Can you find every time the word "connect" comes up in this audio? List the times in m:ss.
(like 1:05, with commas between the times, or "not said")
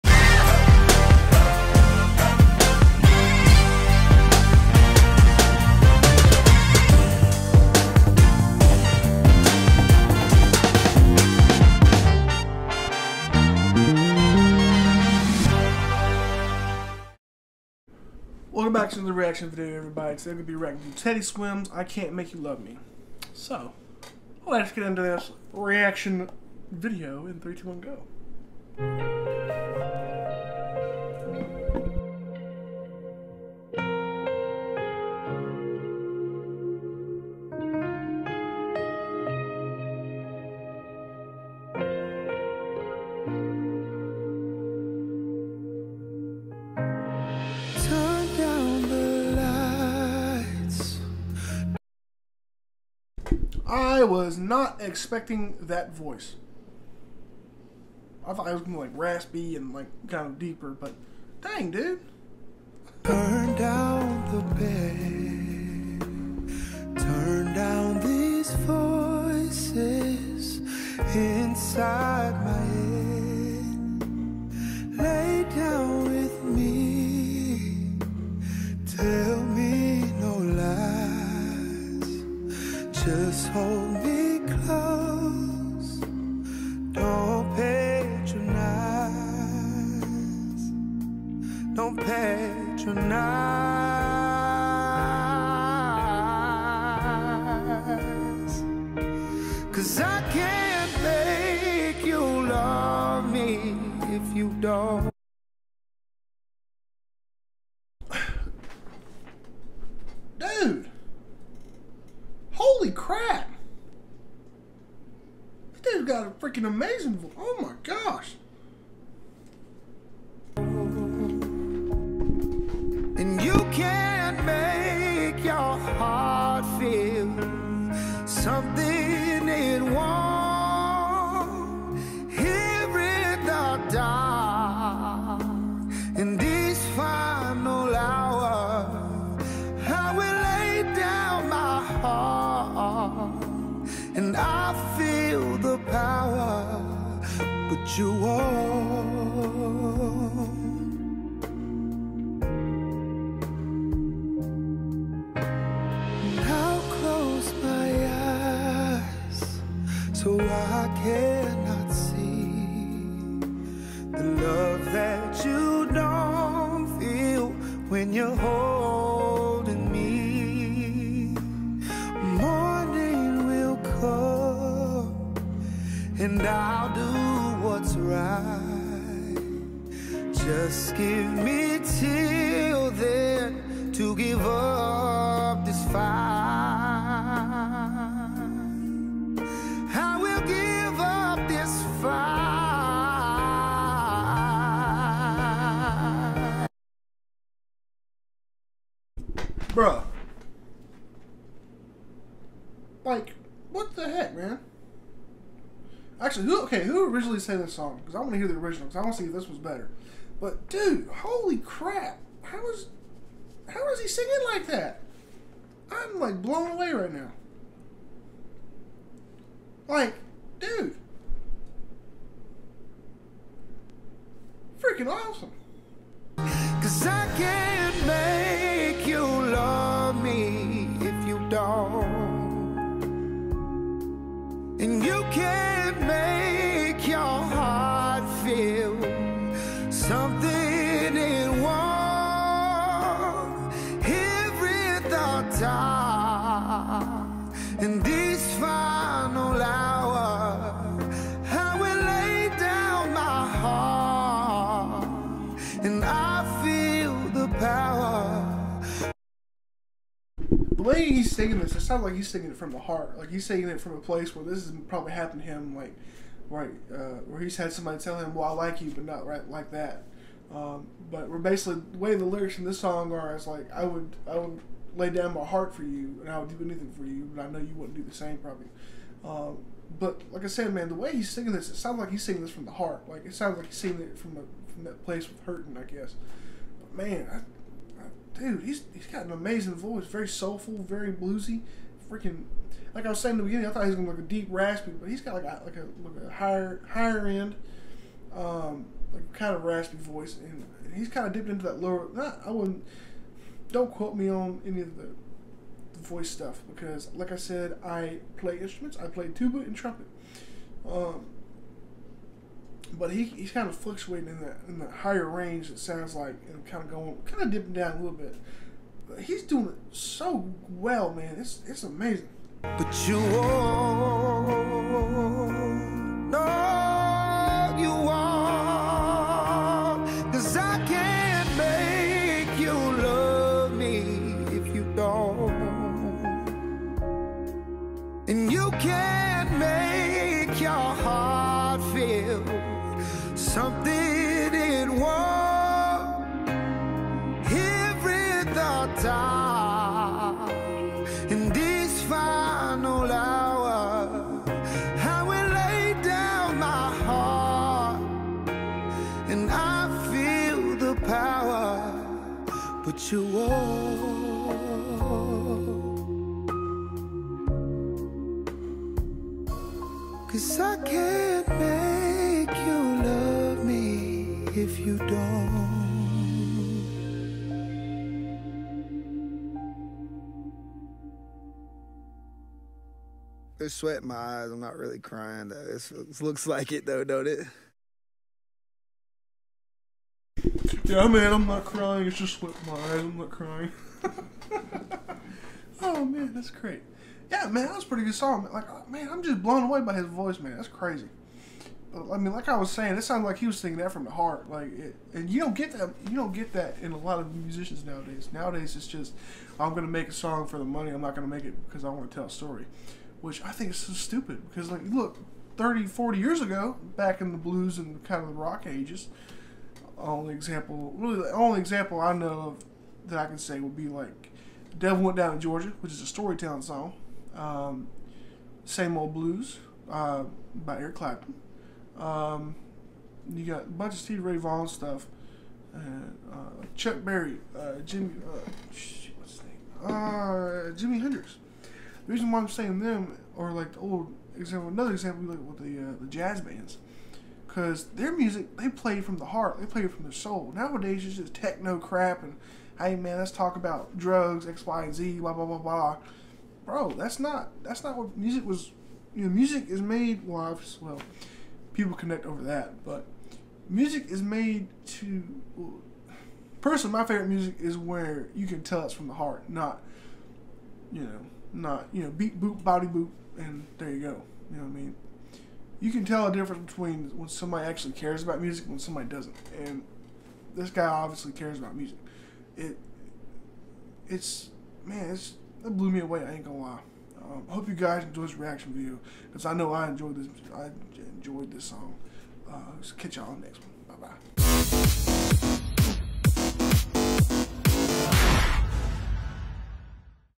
7:41.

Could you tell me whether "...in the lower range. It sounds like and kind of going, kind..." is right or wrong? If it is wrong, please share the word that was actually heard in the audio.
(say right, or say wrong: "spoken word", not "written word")
wrong: "higher", not "lower".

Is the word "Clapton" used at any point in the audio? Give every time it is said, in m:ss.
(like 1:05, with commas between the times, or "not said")
7:10.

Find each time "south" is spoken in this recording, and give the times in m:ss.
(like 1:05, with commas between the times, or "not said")
not said.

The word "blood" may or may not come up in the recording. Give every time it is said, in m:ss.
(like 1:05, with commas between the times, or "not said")
not said.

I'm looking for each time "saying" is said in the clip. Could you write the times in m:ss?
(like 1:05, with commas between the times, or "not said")
4:53, 6:42, 7:22.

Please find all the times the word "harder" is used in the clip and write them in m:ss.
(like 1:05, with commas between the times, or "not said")
not said.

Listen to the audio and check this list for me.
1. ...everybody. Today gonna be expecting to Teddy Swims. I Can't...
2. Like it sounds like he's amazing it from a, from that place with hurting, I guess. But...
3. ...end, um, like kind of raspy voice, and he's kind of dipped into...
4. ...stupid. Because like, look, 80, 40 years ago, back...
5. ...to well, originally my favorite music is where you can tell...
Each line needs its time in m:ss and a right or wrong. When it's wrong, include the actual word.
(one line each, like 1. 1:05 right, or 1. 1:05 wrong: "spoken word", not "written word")
1. 0:19 wrong: "reacting", not "expecting"
2. 4:43 wrong: "singing", not "amazing"
3. 4:57 right
4. 6:53 wrong: "30", not "80"
5. 7:44 wrong: "personally", not "originally".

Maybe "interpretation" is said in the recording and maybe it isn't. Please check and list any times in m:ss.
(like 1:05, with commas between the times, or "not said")
not said.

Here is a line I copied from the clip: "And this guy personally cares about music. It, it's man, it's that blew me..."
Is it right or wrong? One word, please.
wrong.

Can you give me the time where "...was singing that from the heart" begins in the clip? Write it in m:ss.
6:43.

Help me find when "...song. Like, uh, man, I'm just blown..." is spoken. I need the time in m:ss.
6:38.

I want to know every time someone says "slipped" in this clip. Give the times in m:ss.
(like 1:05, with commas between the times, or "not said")
6:32.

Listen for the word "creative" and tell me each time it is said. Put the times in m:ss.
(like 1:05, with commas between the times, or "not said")
not said.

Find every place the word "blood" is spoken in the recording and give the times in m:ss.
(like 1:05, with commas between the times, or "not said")
not said.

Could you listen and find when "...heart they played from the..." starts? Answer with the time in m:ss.
7:29.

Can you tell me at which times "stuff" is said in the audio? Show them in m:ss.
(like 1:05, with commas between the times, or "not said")
5:06, 7:14.